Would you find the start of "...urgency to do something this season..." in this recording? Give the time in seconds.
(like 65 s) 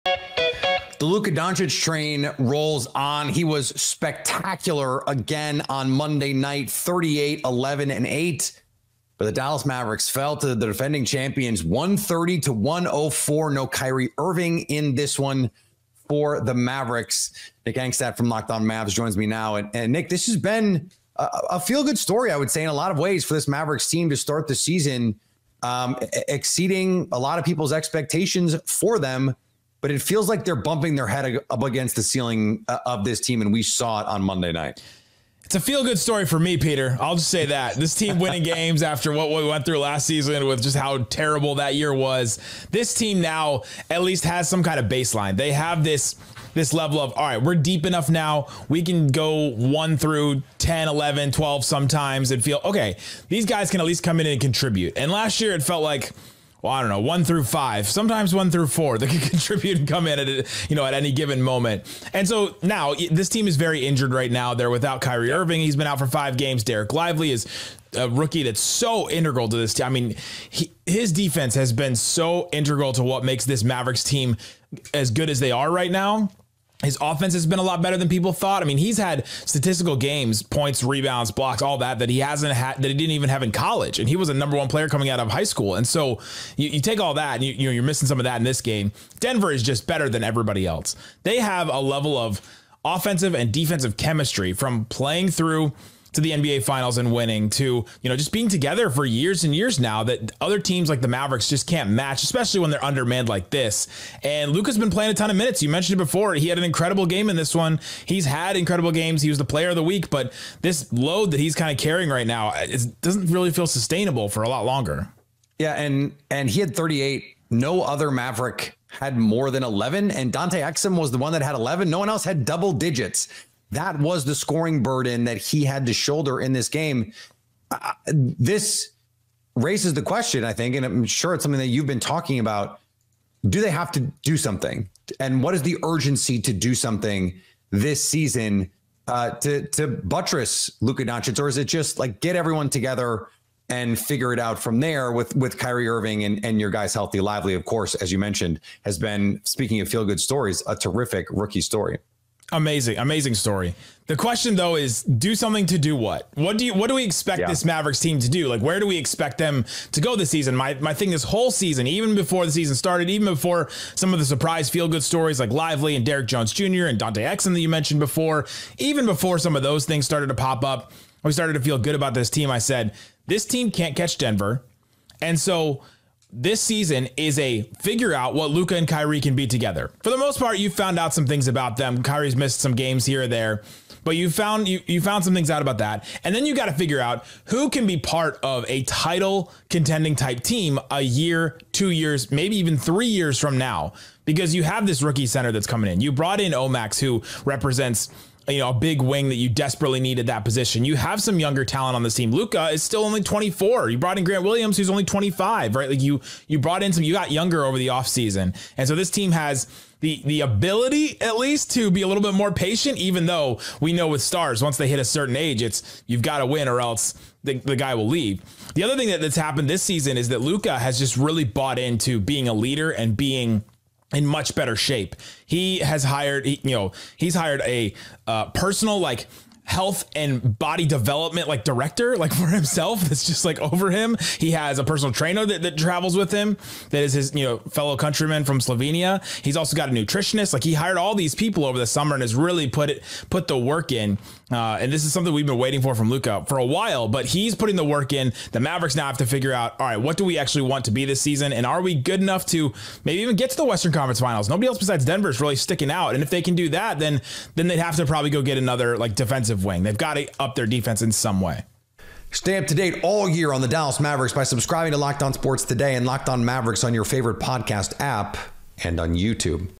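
135 s.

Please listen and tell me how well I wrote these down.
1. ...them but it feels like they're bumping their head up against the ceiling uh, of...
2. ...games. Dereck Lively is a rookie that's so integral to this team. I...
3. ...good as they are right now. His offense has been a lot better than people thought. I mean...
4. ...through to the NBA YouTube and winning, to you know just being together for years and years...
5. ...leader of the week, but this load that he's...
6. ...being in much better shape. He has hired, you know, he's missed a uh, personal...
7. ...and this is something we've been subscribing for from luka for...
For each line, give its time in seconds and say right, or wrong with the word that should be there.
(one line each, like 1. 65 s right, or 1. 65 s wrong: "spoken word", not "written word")
1. 28 s right
2. 66 s right
3. 75 s right
4. 95 s wrong: "Finals", not "YouTube"
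5. 109 s wrong: "player", not "leader"
6. 223 s wrong: "hired", not "missed"
7. 244 s wrong: "waiting", not "subscribing".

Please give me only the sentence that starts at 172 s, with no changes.
I said, this team can't catch Denver.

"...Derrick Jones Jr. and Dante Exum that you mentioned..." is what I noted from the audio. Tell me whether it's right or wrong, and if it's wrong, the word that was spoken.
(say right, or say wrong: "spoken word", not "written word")
right.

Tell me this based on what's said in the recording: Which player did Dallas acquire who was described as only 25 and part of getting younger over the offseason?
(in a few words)
Grant Williams.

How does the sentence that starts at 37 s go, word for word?
This team winning games after what we went through last season with just how terrible that year was.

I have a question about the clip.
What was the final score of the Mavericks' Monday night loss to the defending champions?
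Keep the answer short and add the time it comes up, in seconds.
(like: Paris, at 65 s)
130 to 104, at 11 s.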